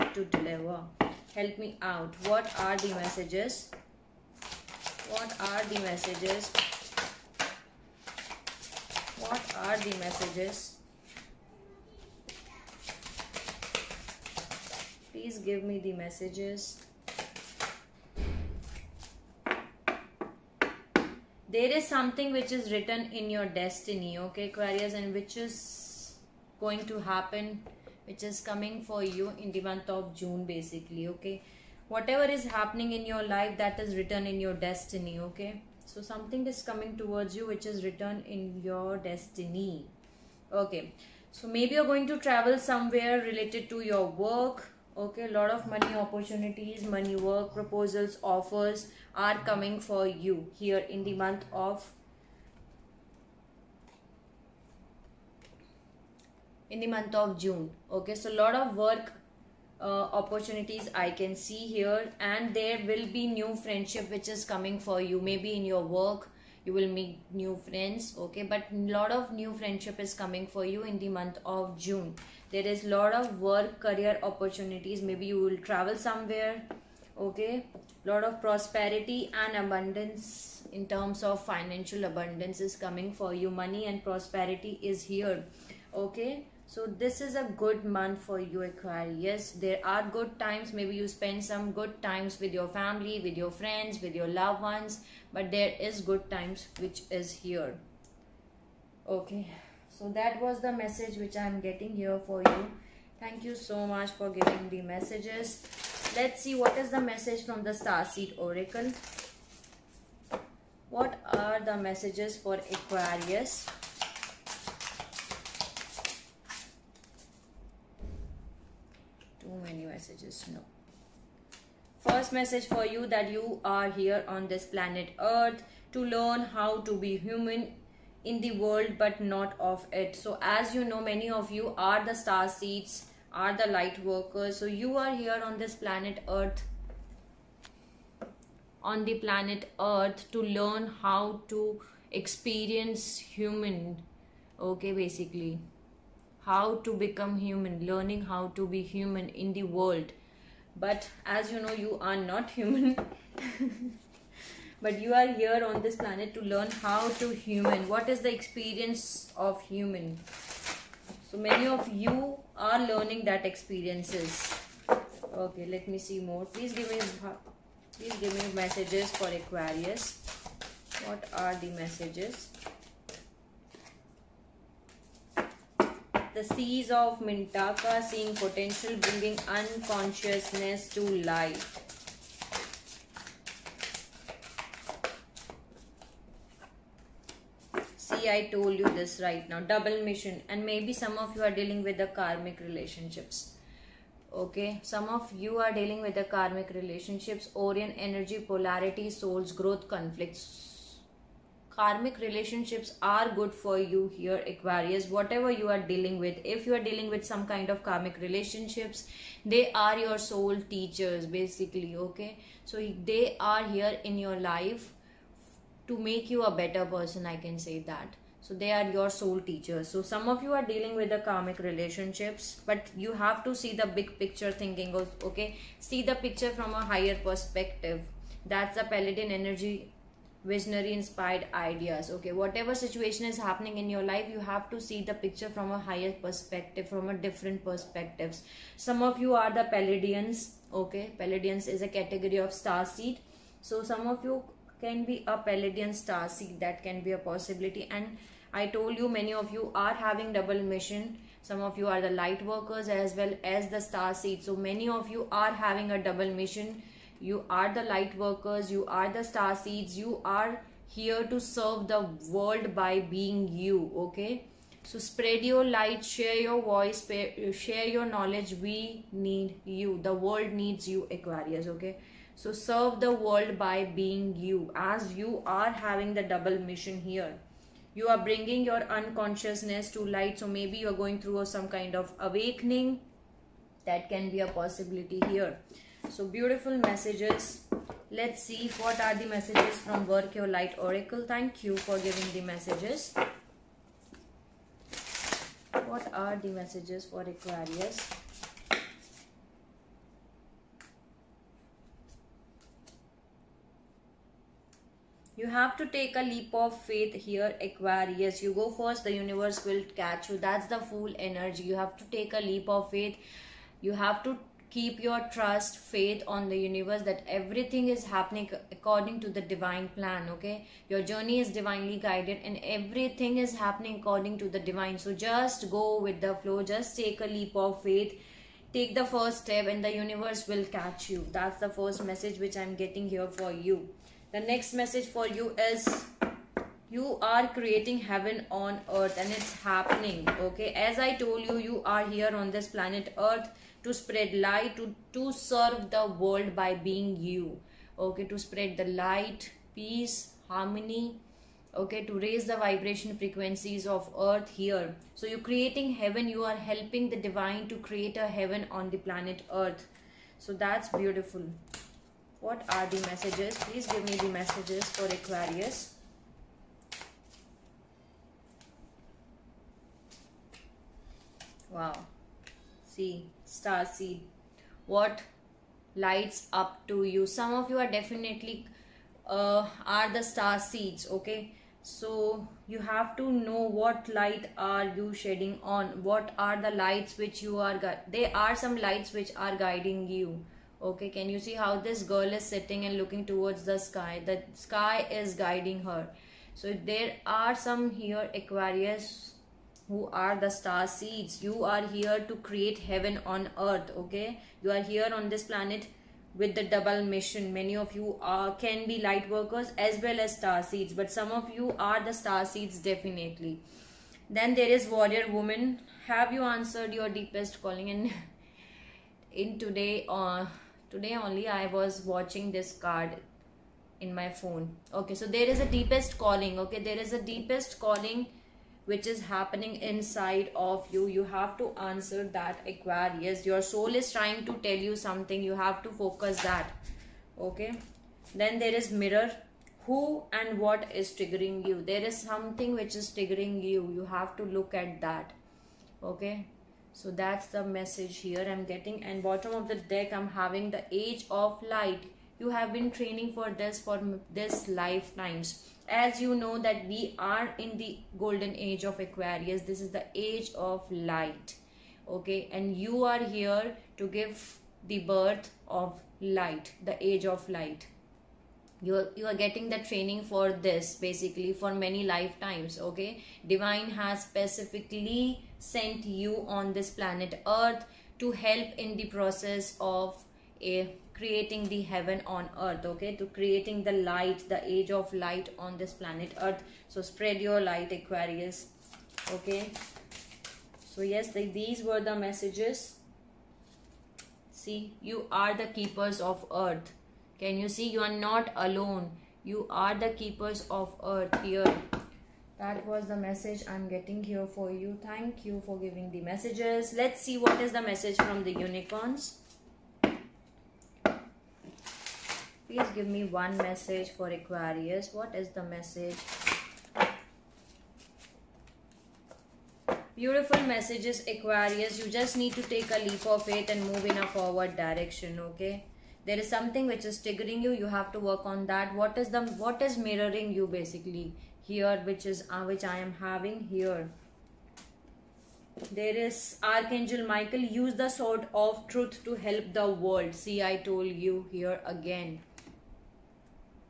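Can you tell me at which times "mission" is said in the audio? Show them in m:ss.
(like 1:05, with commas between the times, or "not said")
3:10, 4:10, 4:16, 4:36, 6:47.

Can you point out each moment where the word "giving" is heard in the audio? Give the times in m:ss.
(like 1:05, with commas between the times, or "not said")
1:44, 4:51, 8:25.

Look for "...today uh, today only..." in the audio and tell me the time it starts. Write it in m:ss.
6:59.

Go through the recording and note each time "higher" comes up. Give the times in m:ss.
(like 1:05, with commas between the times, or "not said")
3:46, 3:55.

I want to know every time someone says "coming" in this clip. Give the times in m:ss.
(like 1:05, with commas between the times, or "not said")
0:28, 0:36, 0:49, 1:04, 1:10, 1:22.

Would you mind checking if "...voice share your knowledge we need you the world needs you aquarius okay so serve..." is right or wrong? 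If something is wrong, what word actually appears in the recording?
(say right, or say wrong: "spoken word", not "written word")
right.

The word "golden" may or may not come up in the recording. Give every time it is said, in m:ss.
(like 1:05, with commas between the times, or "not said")
7:38.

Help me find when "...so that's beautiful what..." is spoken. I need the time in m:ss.
6:00.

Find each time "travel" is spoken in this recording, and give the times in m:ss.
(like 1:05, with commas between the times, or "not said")
0:42, 1:15.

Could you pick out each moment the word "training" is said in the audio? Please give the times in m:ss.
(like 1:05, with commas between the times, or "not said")
7:33, 7:49.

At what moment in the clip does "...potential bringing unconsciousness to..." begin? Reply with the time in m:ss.
2:58.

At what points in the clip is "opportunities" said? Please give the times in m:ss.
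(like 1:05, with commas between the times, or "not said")
0:46, 1:00, 1:14.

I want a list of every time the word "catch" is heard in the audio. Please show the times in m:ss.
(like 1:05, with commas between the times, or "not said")
5:09, 5:30.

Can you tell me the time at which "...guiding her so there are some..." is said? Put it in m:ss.
6:35.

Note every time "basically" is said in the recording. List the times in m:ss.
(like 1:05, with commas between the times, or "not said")
0:30, 2:24, 3:31, 7:50, 8:50.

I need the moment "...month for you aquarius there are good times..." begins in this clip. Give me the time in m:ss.
1:27.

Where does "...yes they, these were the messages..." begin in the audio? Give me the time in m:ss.
8:11.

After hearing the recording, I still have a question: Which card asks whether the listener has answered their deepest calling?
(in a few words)
Warrior woman.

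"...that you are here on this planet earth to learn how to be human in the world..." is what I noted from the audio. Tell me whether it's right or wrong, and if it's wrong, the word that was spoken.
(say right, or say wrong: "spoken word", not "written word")
right.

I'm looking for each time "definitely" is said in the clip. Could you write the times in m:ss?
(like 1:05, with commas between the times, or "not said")
6:17, 6:52.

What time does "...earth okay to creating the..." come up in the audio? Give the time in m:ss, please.
8:02.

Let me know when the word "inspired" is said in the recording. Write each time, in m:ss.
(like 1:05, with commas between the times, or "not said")
3:50.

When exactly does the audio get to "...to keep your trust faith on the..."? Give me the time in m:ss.
5:14.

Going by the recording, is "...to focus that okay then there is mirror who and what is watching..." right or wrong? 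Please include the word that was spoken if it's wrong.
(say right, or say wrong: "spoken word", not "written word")
wrong: "triggering", not "watching".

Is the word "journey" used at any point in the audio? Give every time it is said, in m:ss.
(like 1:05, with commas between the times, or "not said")
5:21.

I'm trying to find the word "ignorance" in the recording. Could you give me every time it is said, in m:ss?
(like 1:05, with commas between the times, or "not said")
not said.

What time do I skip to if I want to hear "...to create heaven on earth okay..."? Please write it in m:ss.
6:42.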